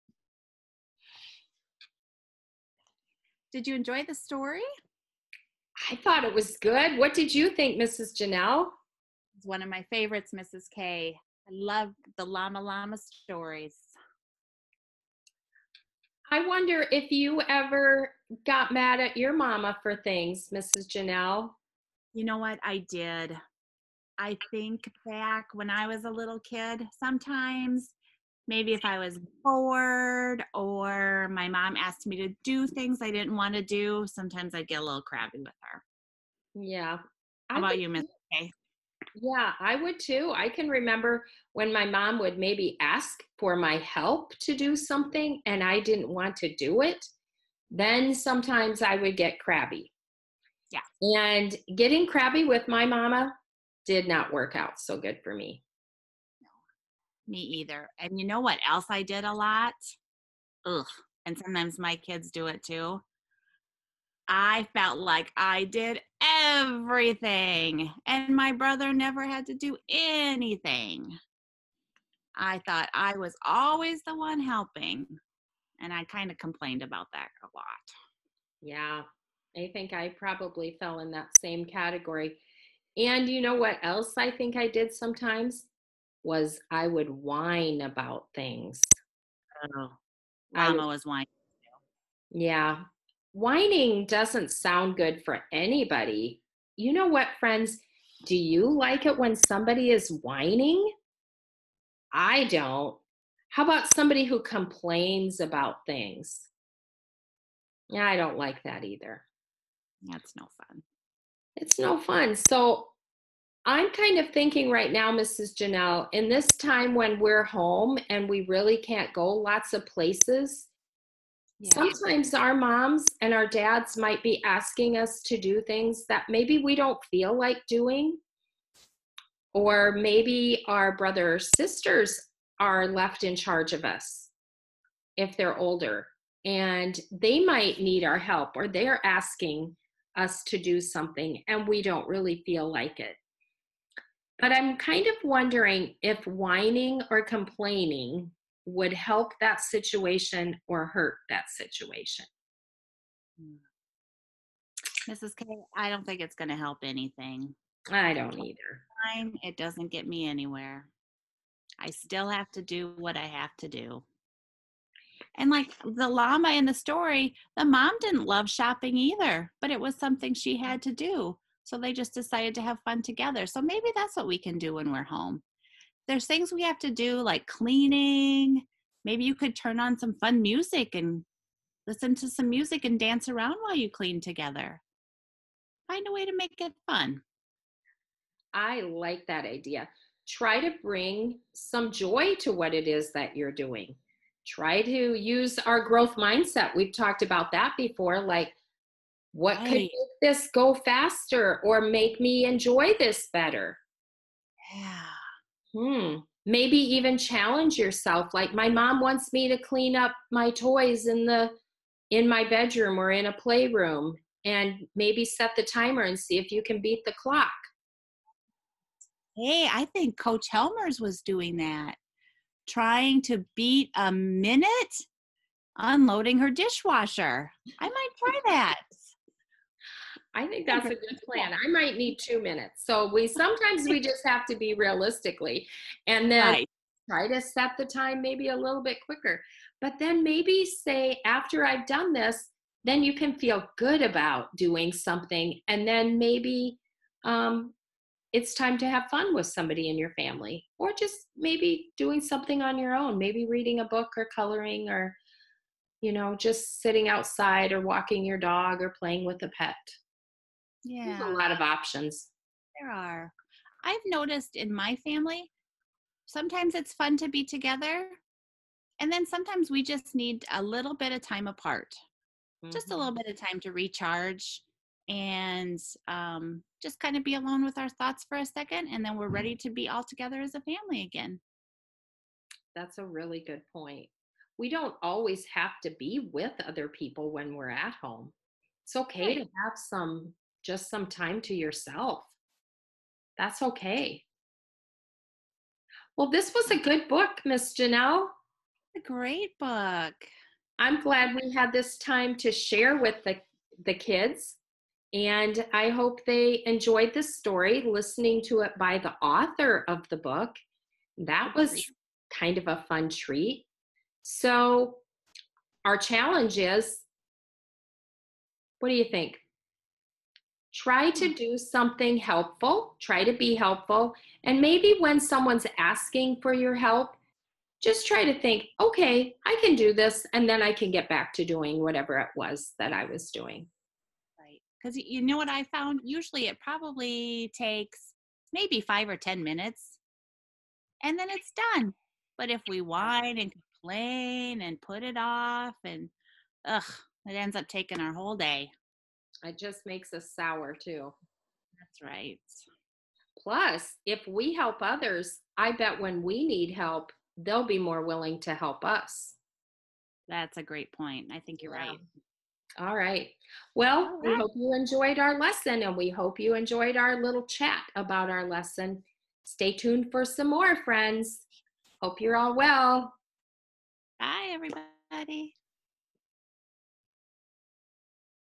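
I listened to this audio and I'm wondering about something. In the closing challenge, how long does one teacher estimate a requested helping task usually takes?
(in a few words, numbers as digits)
5 or 10 minutes.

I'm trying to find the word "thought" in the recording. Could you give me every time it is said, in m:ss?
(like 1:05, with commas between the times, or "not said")
0:05, 1:12, 4:37.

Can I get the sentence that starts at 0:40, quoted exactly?
I can remember when my mom would maybe ask for my help to do something and I didn't want to do it.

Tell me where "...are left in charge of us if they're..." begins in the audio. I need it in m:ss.
2:12.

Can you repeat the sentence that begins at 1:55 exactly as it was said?
Janelle, in this time when we're home and we really can't go lots of places, yeah.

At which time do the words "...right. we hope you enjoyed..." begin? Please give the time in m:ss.
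6:04.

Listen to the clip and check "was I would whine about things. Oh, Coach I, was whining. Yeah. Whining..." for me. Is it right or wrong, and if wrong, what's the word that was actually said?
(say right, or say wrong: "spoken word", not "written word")
wrong: "Mama", not "Coach".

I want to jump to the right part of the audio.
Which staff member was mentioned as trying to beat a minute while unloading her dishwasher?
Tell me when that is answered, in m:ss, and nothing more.
3:40.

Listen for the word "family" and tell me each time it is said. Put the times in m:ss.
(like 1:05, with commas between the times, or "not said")
4:10, 4:24, 4:40.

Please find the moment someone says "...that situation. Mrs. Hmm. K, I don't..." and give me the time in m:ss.
2:31.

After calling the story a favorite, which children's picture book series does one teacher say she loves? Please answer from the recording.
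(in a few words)
Llama llama stories.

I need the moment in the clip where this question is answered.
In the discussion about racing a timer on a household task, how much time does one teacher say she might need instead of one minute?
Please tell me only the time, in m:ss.
3:52.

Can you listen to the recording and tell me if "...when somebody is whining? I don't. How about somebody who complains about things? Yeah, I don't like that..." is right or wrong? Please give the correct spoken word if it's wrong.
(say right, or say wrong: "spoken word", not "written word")
right.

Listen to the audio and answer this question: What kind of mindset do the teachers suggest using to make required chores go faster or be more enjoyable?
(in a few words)
Growth mindset.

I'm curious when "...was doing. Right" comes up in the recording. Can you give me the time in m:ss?
5:33.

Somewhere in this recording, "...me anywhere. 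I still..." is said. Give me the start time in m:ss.
2:40.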